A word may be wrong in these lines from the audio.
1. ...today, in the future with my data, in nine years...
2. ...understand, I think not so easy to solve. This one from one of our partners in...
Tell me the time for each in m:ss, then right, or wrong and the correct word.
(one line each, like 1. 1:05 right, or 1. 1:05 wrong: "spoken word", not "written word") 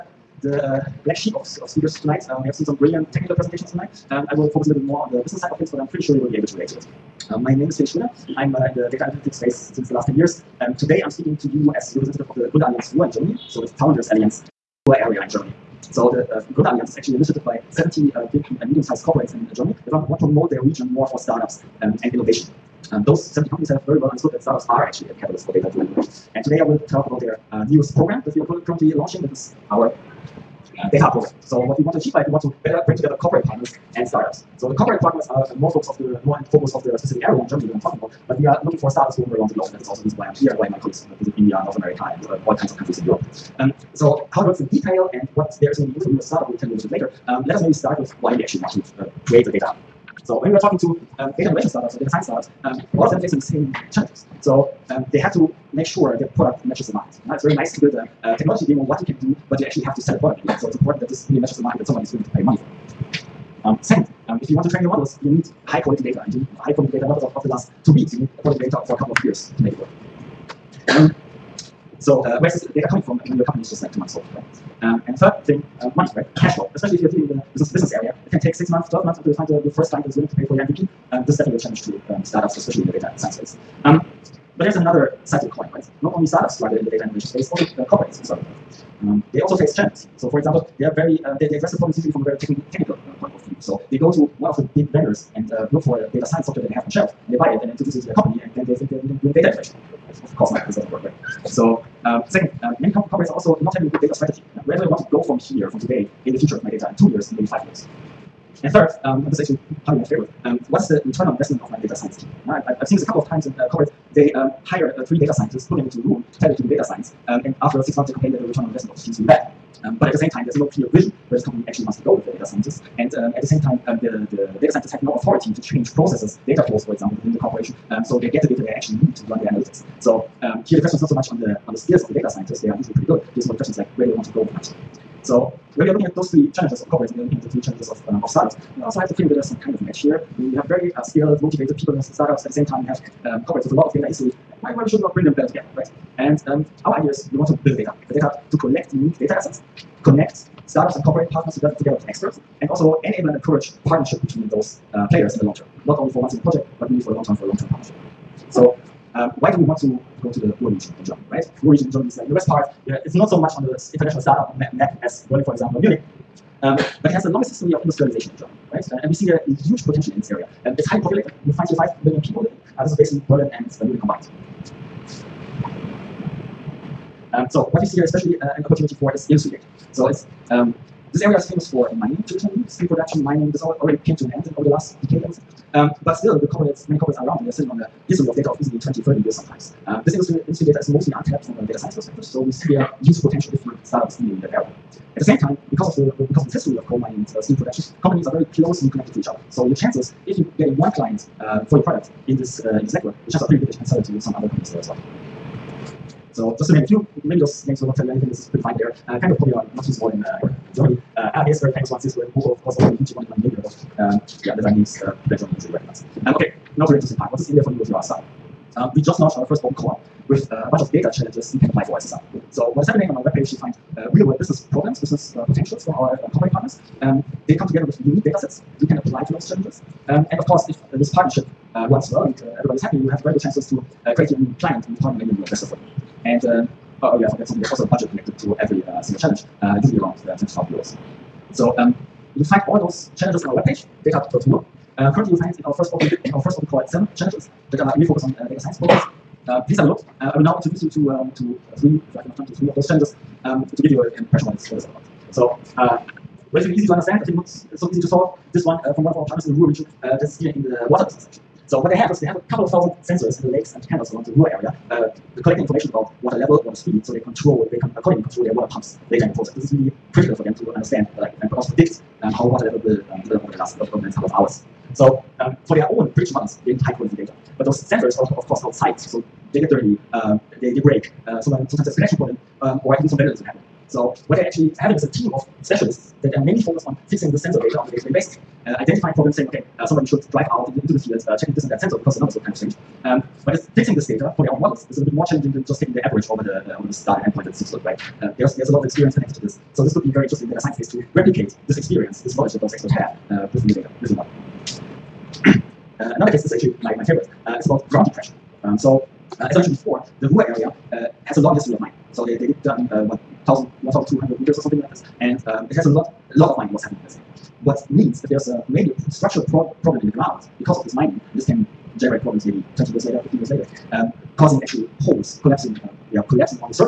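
1. 1:45 wrong: "two", not "nine"
2. 4:16 right.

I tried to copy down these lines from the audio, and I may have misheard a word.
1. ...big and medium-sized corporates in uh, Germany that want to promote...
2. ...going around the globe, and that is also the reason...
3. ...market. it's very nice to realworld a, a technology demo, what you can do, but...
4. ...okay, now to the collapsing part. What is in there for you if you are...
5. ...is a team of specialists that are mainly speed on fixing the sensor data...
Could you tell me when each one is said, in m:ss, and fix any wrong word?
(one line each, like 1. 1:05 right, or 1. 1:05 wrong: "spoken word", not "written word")
1. 0:18 right
2. 0:39 right
3. 0:56 wrong: "build", not "realworld"
4. 3:36 wrong: "interesting", not "collapsing"
5. 4:44 wrong: "focused", not "speed".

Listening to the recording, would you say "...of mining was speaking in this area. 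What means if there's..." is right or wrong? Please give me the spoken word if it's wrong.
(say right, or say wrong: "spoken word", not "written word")
wrong: "happening", not "speaking".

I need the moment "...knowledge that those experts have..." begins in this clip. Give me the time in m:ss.
5:02.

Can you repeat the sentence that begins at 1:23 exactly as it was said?
Um, but there's another side to the coin, right?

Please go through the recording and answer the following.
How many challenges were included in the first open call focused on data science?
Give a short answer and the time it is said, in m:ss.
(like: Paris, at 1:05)
7, at 4:06.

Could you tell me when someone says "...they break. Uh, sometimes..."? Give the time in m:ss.
4:40.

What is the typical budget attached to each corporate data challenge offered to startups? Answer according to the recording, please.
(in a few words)
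20,000 euros.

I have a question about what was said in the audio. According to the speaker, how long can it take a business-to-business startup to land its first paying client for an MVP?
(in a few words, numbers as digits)
6 to 12 months.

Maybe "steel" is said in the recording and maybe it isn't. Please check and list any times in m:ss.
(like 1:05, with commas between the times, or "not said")
3:02, 3:17.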